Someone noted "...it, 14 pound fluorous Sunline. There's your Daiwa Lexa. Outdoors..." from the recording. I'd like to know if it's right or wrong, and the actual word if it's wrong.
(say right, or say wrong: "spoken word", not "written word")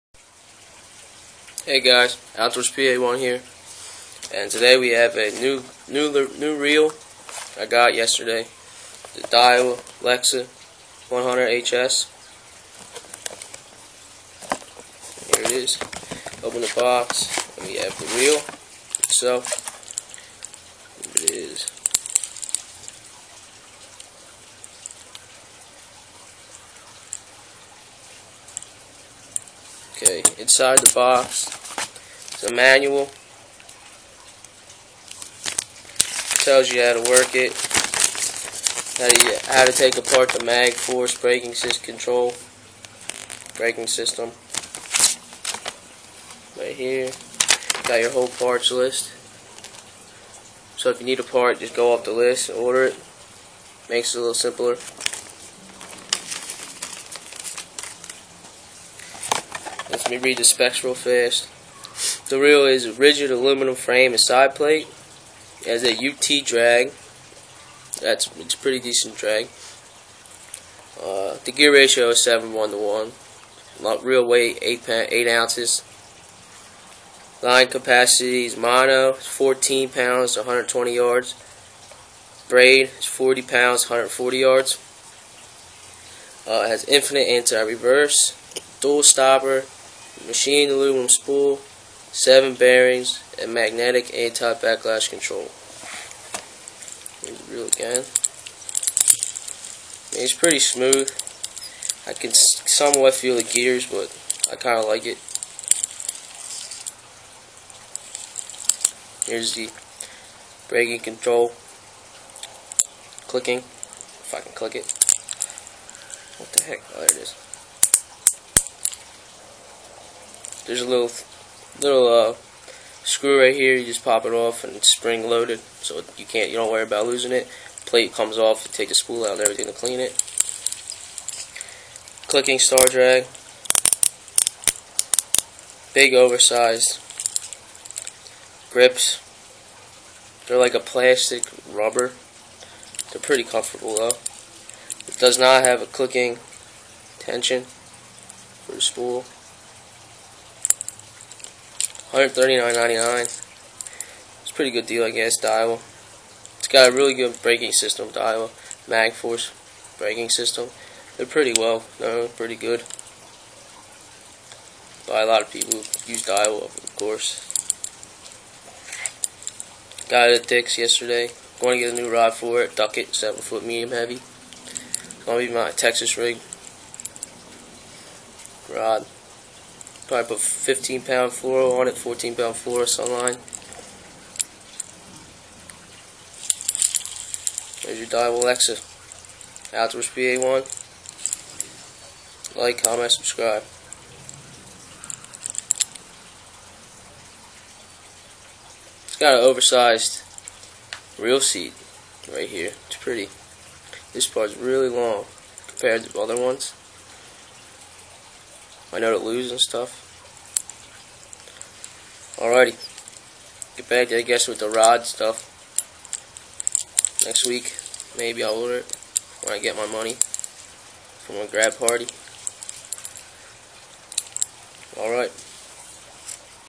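right.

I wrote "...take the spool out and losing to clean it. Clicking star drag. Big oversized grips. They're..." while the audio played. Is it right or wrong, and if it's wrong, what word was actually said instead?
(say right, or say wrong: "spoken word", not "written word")
wrong: "everything", not "losing".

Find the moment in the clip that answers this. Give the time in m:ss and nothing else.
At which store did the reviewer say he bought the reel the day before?
2:50.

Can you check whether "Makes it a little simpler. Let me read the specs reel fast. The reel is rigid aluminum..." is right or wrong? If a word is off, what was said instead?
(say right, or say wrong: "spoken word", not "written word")
right.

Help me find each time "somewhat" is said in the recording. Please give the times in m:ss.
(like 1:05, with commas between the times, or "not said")
1:42.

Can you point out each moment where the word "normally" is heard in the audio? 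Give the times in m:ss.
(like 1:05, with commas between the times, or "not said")
not said.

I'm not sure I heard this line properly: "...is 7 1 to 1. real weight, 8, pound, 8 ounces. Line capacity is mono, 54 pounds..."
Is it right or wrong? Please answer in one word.
wrong.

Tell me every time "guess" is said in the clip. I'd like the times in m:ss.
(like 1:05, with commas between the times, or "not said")
2:35, 3:34.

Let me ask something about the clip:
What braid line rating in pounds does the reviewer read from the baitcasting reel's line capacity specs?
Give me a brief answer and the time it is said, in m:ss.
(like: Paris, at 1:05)
40 pounds, at 1:23.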